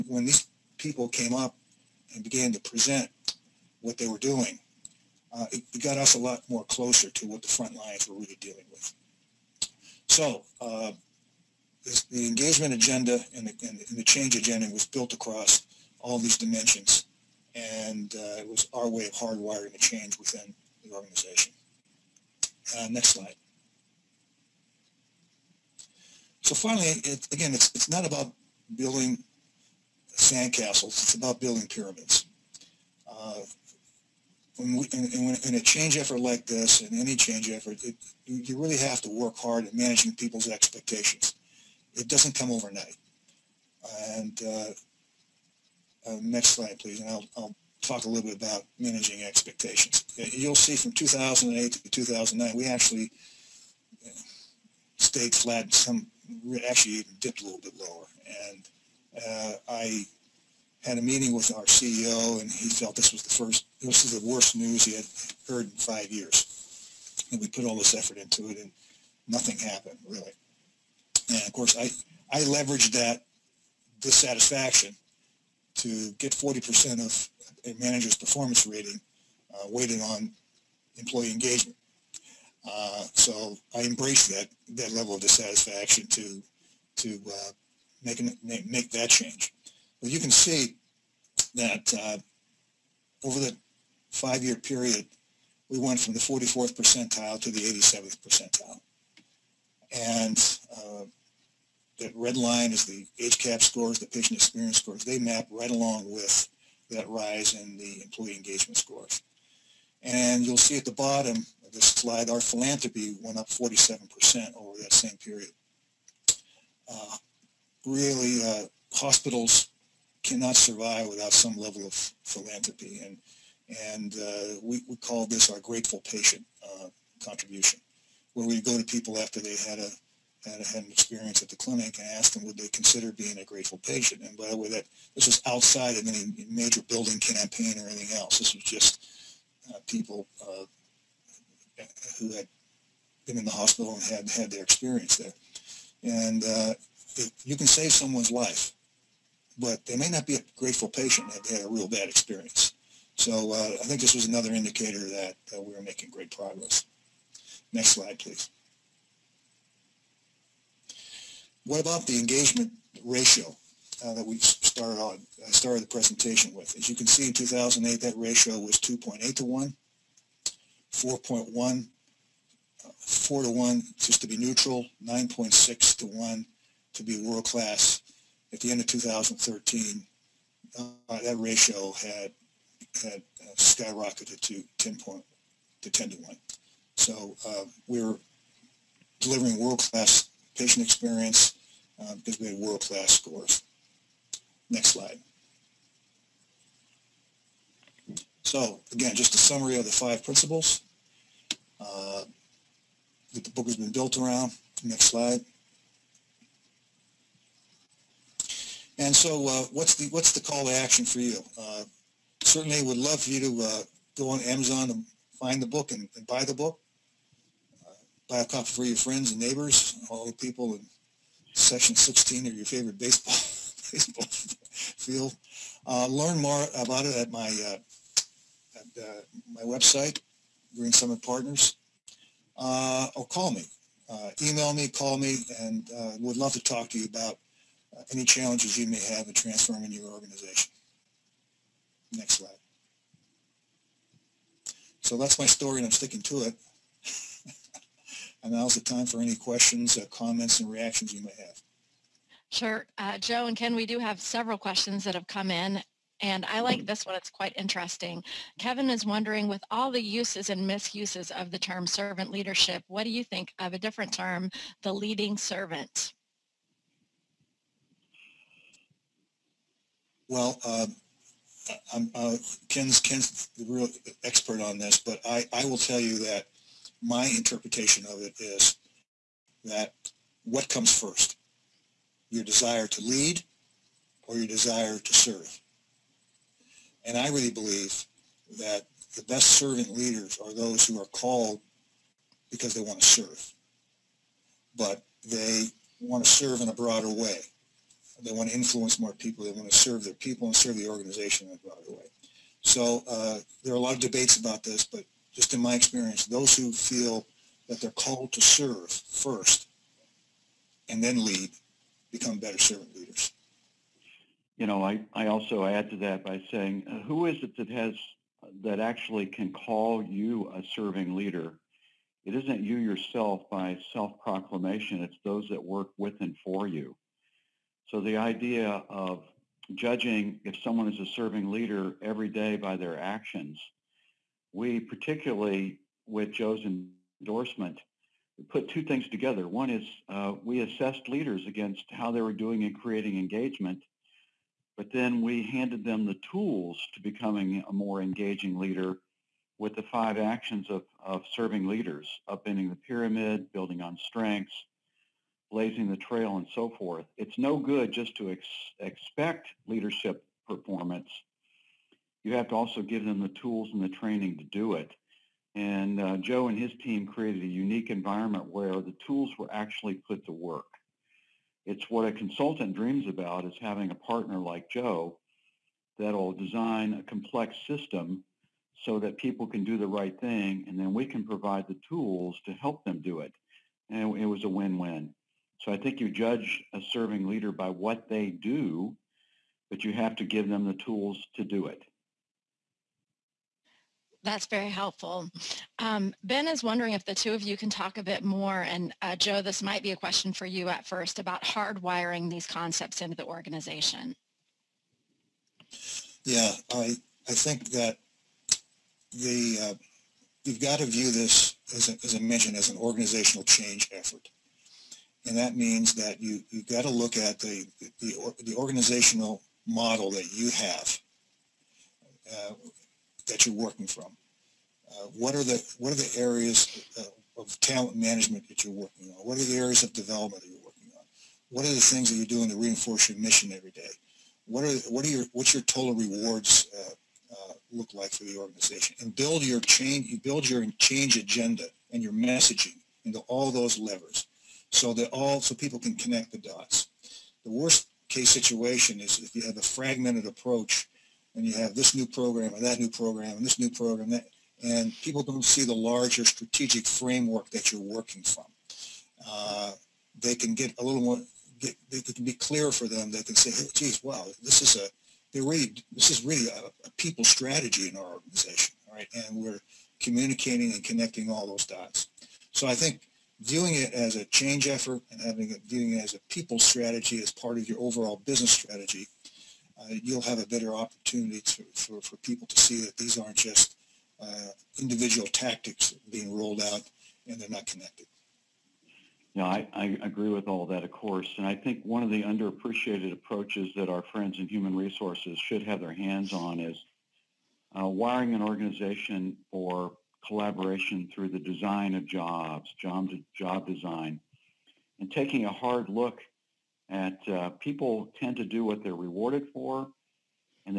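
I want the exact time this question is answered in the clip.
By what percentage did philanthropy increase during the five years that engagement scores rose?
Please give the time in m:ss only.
1:53.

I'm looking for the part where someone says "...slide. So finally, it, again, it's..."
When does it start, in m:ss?
0:23.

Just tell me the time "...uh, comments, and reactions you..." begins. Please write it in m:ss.
4:09.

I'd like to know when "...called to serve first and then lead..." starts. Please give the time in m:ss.
5:07.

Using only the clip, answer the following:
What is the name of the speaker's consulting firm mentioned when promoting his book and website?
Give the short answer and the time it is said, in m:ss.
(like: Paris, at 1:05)
Green Summit Partners, at 3:50.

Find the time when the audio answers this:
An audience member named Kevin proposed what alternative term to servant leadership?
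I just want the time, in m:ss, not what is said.
4:24.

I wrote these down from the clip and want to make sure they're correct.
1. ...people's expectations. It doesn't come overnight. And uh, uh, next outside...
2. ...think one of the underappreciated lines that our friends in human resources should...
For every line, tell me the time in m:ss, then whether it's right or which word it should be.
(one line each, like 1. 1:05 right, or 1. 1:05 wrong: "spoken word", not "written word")
1. 0:40 wrong: "slide", not "outside"
2. 8:11 wrong: "approaches", not "lines".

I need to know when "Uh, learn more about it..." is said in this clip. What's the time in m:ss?
3:45.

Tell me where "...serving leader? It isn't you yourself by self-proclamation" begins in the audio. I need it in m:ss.
5:20.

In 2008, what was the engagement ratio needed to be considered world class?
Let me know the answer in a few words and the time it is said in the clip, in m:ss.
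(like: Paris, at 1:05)
9.6 to 1, at 2:55.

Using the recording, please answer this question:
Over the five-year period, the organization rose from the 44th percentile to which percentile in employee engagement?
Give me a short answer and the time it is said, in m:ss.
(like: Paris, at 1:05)
87th, at 1:37.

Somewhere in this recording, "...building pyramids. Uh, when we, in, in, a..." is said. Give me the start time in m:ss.
0:31.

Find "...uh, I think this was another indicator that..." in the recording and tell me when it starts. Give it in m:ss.
2:33.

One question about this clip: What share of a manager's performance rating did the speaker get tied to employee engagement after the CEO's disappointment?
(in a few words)
40%.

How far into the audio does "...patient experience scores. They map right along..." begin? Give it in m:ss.
1:44.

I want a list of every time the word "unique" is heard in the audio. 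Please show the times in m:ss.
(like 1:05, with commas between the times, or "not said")
6:07.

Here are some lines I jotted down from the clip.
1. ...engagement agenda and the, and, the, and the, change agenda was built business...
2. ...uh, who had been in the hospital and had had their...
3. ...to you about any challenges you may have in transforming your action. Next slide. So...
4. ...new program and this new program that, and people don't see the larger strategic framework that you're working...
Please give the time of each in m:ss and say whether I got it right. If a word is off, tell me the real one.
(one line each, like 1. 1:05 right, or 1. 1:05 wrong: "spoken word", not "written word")
1. 0:12 wrong: "across", not "business"
2. 2:20 right
3. 3:56 wrong: "organization", not "action"
4. 7:32 right.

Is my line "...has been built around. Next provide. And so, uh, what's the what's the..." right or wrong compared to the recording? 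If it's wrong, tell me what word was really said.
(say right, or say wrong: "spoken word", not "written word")
wrong: "slide", not "provide".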